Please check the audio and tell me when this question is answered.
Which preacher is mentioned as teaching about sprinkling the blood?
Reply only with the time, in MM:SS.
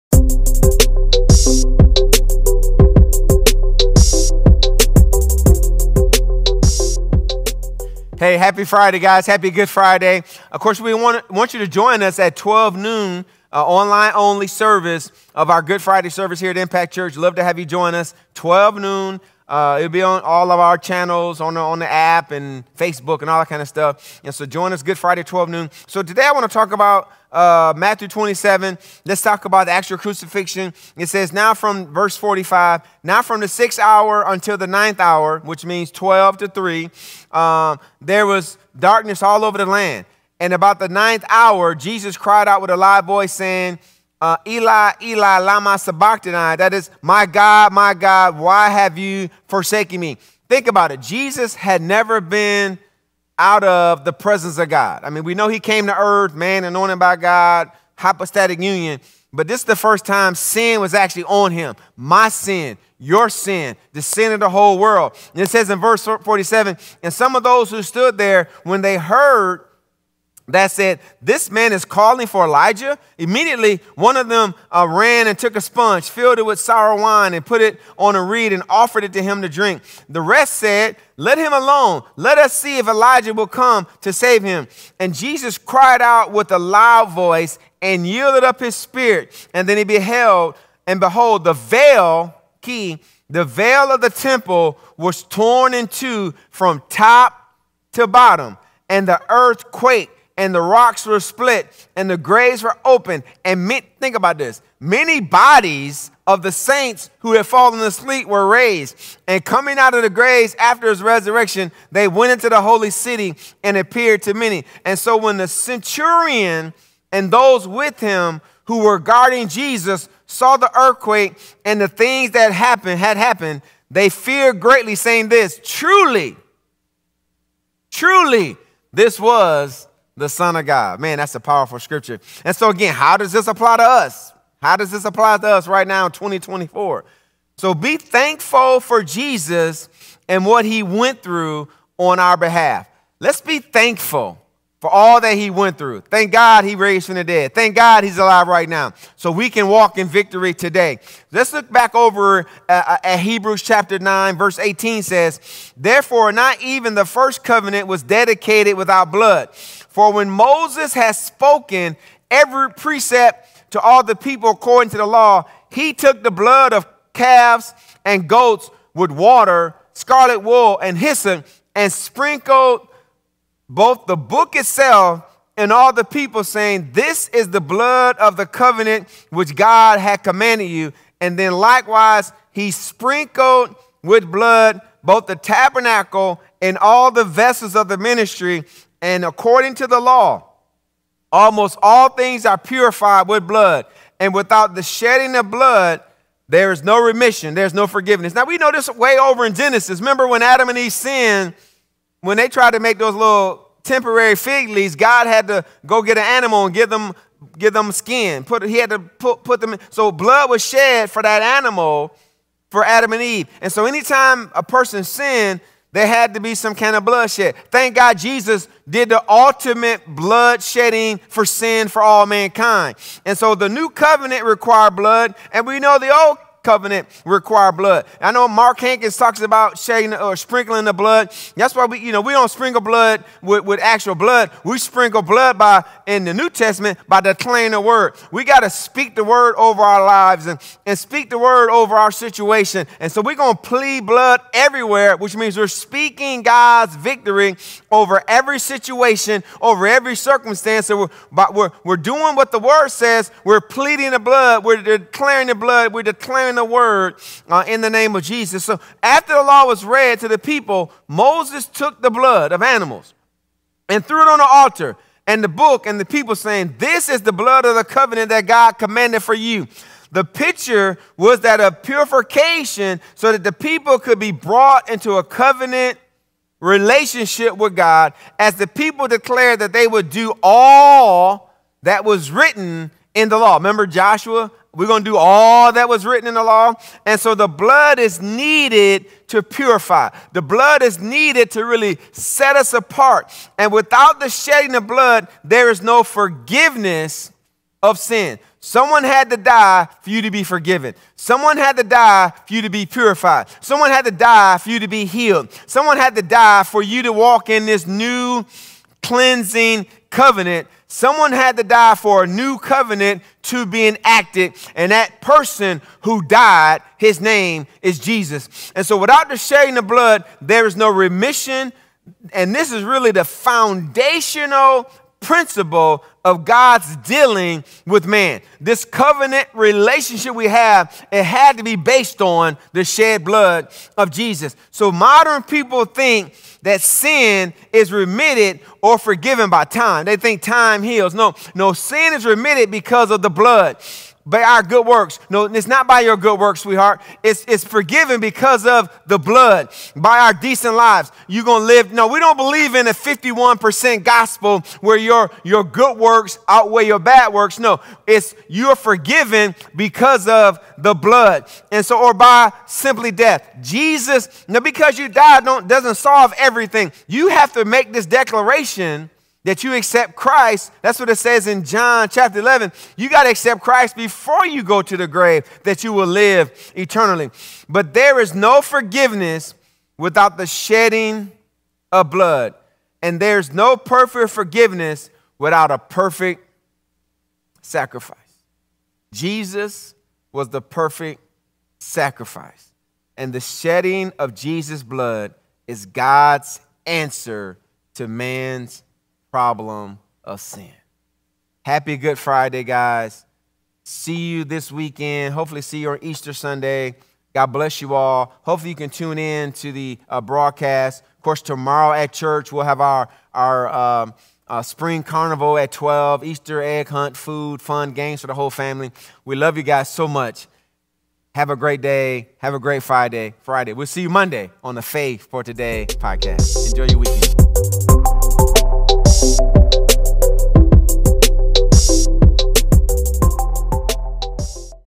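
03:48.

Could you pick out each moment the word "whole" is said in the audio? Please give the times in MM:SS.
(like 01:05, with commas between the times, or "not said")
01:04, 06:58.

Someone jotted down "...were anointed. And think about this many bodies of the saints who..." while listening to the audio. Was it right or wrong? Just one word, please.
wrong.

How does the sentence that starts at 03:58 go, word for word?
We got to speak the word over our lives and, and speak the word over our situation.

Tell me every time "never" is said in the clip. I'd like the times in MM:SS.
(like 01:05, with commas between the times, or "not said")
00:51.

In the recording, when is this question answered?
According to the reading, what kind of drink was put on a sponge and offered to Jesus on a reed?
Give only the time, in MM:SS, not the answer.
01:16.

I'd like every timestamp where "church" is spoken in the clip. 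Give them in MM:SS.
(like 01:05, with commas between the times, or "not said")
00:16, 06:52.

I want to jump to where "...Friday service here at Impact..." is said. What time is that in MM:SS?
00:15.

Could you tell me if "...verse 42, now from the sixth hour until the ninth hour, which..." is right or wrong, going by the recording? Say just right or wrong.
wrong.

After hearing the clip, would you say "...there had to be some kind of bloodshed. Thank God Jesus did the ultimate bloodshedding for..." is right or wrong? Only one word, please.
right.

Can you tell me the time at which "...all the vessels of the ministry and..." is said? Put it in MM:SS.
03:06.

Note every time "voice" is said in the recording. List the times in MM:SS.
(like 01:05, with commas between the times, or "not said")
00:43, 01:27.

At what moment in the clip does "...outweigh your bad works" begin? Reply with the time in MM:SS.
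05:56.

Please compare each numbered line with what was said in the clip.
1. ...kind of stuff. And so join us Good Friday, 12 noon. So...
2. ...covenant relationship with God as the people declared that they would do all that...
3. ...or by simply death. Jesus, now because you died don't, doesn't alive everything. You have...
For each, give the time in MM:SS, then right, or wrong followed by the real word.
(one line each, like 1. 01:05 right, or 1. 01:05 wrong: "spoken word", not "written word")
1. 00:23 right
2. 04:35 right
3. 06:02 wrong: "solve", not "alive".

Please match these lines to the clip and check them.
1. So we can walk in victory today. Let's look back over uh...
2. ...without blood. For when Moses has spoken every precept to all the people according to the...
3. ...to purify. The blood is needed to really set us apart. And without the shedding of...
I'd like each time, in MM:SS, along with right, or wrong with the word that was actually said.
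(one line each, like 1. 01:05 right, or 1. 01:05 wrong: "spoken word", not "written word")
1. 02:29 right
2. 02:38 right
3. 04:49 right.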